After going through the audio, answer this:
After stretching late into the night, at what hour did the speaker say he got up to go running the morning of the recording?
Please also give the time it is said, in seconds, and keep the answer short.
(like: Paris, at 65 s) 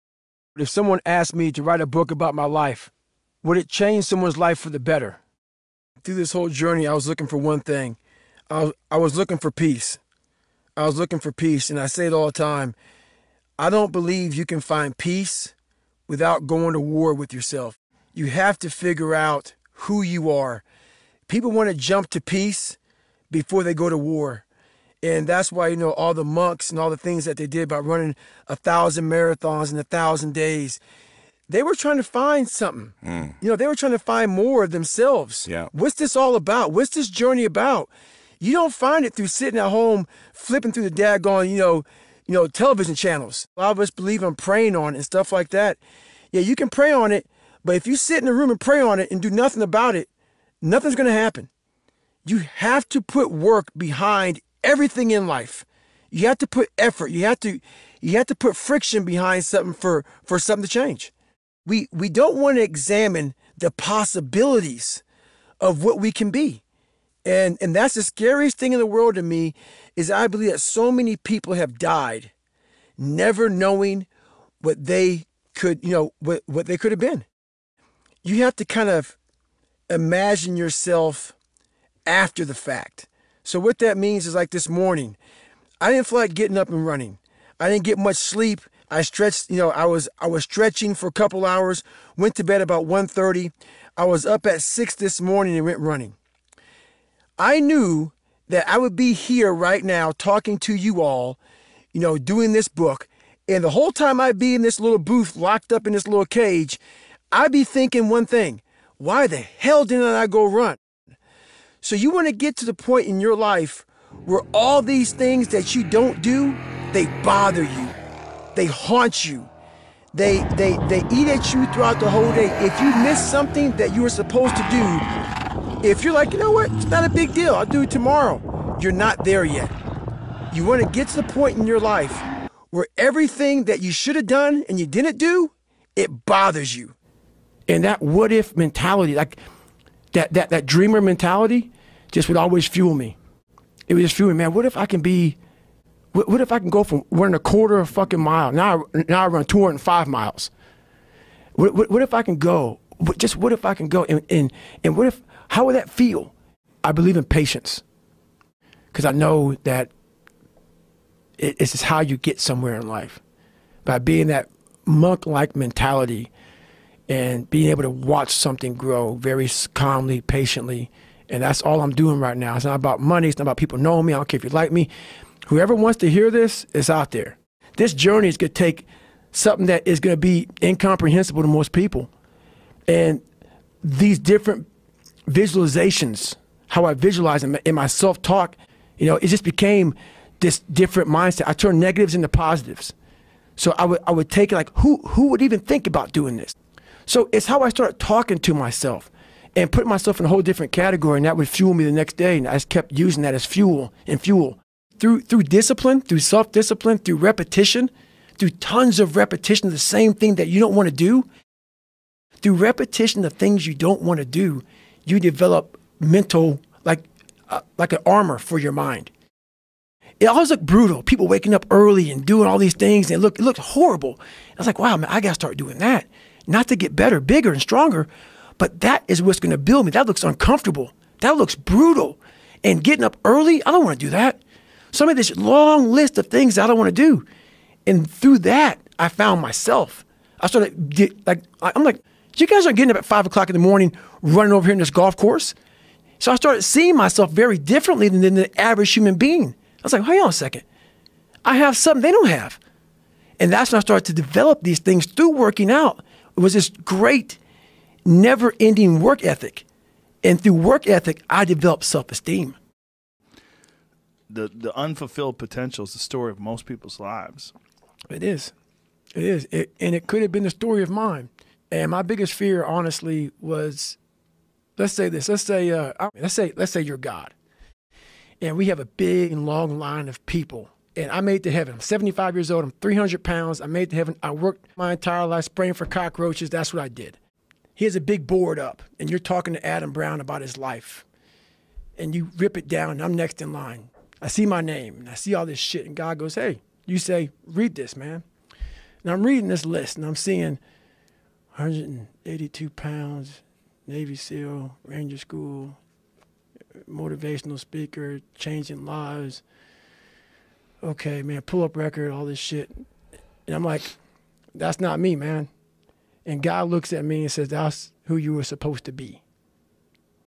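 6, at 94 s.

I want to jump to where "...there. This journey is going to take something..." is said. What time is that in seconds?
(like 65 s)
177 s.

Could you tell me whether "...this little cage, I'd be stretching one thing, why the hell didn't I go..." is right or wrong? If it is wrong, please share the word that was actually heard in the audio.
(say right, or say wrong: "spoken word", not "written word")
wrong: "thinking", not "stretching".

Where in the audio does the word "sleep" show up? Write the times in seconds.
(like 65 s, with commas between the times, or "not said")
88 s.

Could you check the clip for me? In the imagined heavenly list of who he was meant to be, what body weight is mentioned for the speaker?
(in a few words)
182 pounds.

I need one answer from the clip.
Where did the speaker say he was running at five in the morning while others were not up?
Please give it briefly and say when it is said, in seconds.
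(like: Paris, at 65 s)
golf course, at 244 s.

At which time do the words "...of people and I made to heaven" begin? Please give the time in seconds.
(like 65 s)
280 s.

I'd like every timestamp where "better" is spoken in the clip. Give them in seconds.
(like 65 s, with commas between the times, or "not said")
4 s, 226 s.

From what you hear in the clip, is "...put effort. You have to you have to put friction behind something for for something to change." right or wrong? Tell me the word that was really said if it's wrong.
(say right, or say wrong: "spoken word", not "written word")
right.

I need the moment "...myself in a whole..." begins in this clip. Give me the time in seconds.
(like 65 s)
199 s.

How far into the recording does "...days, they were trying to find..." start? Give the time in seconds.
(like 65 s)
30 s.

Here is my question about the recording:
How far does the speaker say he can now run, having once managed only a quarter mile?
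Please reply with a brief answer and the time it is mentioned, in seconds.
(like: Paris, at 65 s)
205 miles, at 149 s.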